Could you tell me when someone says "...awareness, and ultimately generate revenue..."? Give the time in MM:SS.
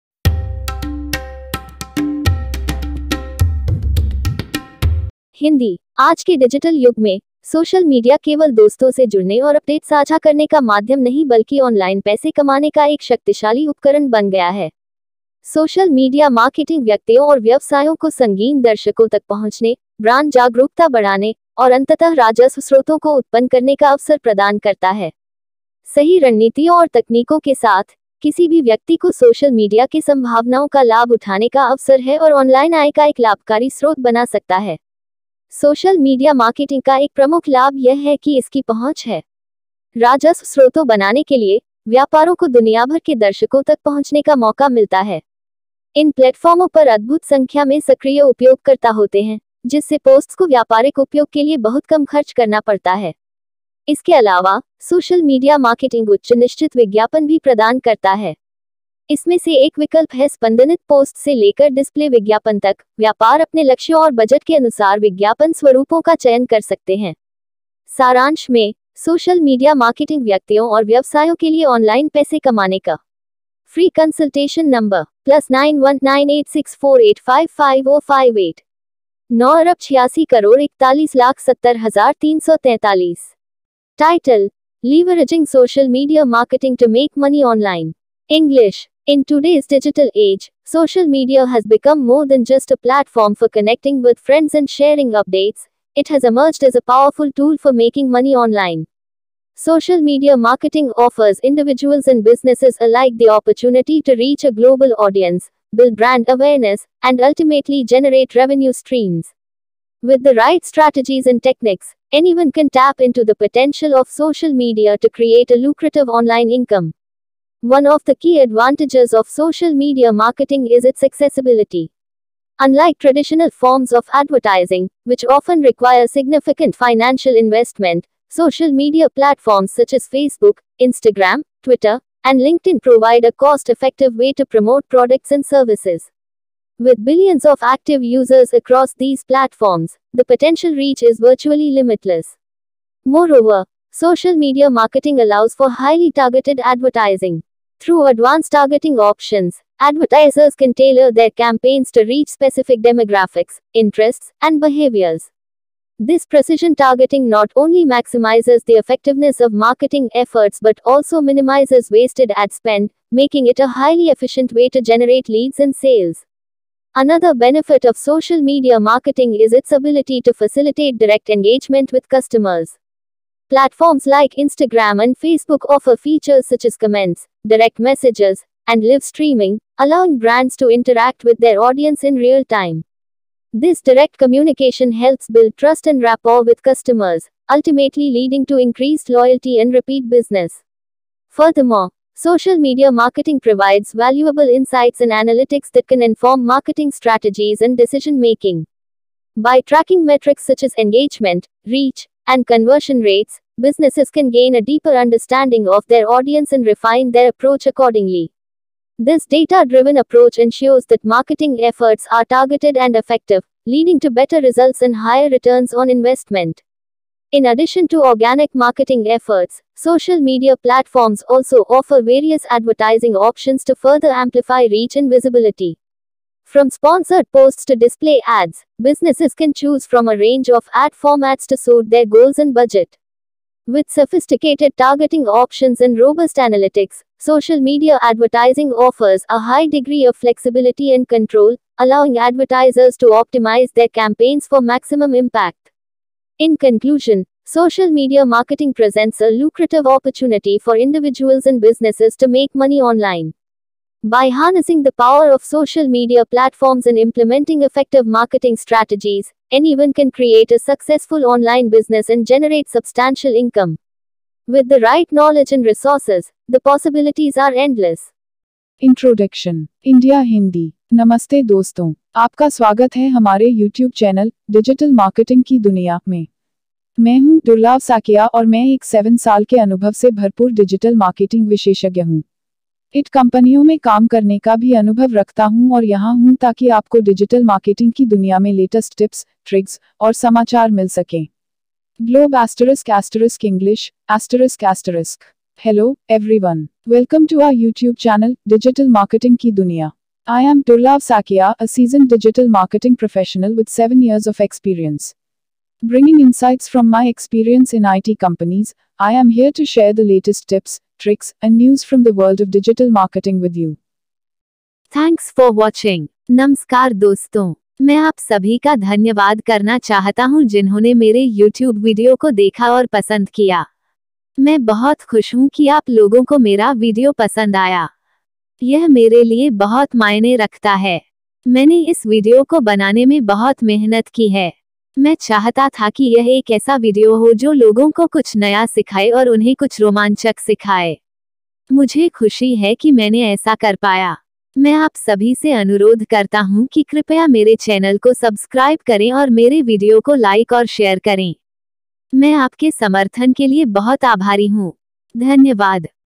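01:46.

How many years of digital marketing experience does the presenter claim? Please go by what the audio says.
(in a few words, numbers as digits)
7.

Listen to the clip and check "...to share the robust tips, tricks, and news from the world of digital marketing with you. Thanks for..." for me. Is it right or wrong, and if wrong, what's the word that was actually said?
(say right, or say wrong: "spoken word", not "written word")
wrong: "latest", not "robust".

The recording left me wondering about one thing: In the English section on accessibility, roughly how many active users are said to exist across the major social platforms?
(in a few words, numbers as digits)
Billions.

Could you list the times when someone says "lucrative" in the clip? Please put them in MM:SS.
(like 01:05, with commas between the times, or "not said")
01:55, 04:09.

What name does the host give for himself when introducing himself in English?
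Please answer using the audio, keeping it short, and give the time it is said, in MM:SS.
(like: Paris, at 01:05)
Durlav Sakia, at 05:00.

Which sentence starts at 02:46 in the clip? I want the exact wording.
Another benefit of social media marketing is its ability to facilitate direct engagement with customers.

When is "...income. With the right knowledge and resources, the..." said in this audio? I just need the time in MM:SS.
04:23.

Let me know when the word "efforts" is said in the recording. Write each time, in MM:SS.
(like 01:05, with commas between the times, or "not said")
02:40, 03:31, 03:39.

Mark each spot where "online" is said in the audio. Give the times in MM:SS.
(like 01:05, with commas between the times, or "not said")
01:38, 01:56, 04:12, 04:21.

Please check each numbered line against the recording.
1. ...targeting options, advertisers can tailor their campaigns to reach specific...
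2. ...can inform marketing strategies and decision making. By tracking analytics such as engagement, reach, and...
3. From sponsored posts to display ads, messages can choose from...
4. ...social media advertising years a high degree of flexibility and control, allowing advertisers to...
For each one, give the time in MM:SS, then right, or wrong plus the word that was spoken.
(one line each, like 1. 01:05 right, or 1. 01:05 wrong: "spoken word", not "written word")
1. 02:28 right
2. 03:15 wrong: "metrics", not "analytics"
3. 03:46 wrong: "businesses", not "messages"
4. 03:57 wrong: "offers", not "years".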